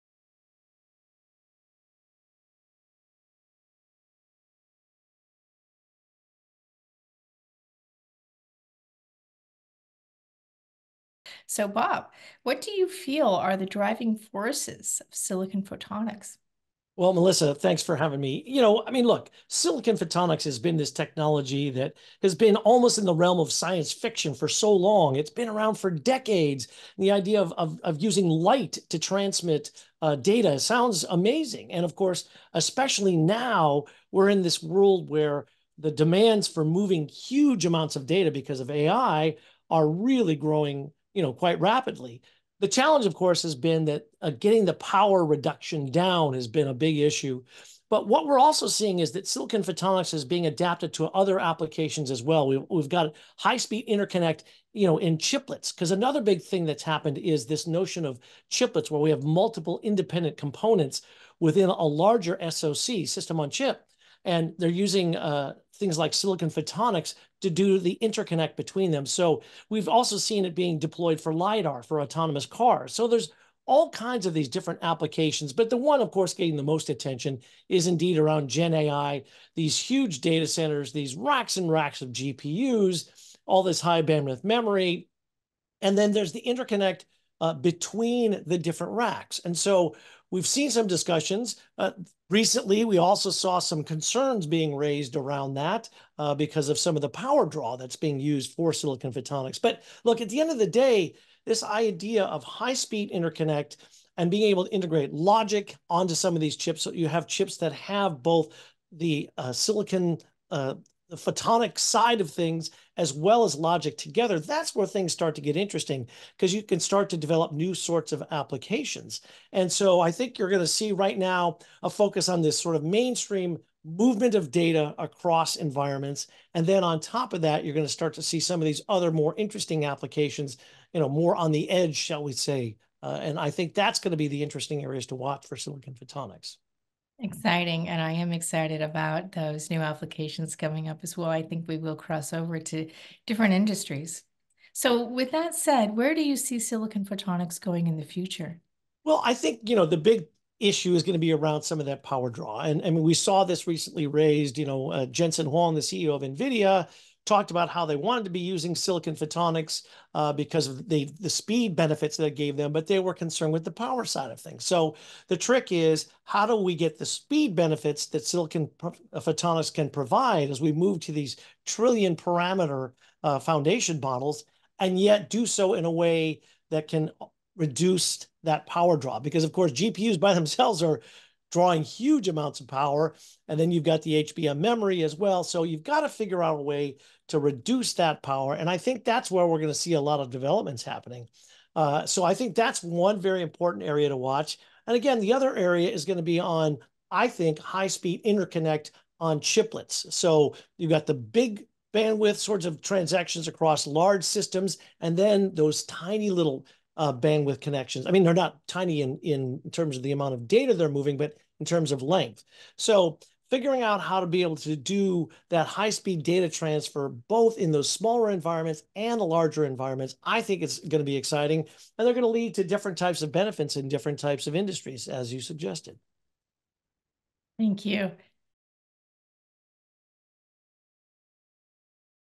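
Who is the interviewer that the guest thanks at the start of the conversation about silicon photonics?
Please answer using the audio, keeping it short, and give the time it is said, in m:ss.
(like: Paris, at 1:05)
Melissa, at 0:17.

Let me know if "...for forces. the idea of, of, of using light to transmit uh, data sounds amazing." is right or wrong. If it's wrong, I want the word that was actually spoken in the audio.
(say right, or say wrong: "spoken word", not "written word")
wrong: "decades", not "forces".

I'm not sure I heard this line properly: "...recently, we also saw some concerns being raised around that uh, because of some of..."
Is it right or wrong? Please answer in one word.
right.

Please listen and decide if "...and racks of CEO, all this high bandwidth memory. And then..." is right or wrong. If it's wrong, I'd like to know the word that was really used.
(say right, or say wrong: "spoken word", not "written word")
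wrong: "GPUs", not "CEO".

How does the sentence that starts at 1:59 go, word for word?
And so I think you're going to see right now a focus on this sort of mainstream movement of data across environments.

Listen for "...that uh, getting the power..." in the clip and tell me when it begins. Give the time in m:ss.
0:43.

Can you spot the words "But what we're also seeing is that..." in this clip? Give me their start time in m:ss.
0:47.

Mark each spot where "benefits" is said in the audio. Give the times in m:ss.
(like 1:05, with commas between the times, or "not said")
2:41, 2:47, 3:43.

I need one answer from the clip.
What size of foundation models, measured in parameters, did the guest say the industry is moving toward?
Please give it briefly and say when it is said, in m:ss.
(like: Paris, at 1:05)
trillion parameter, at 2:51.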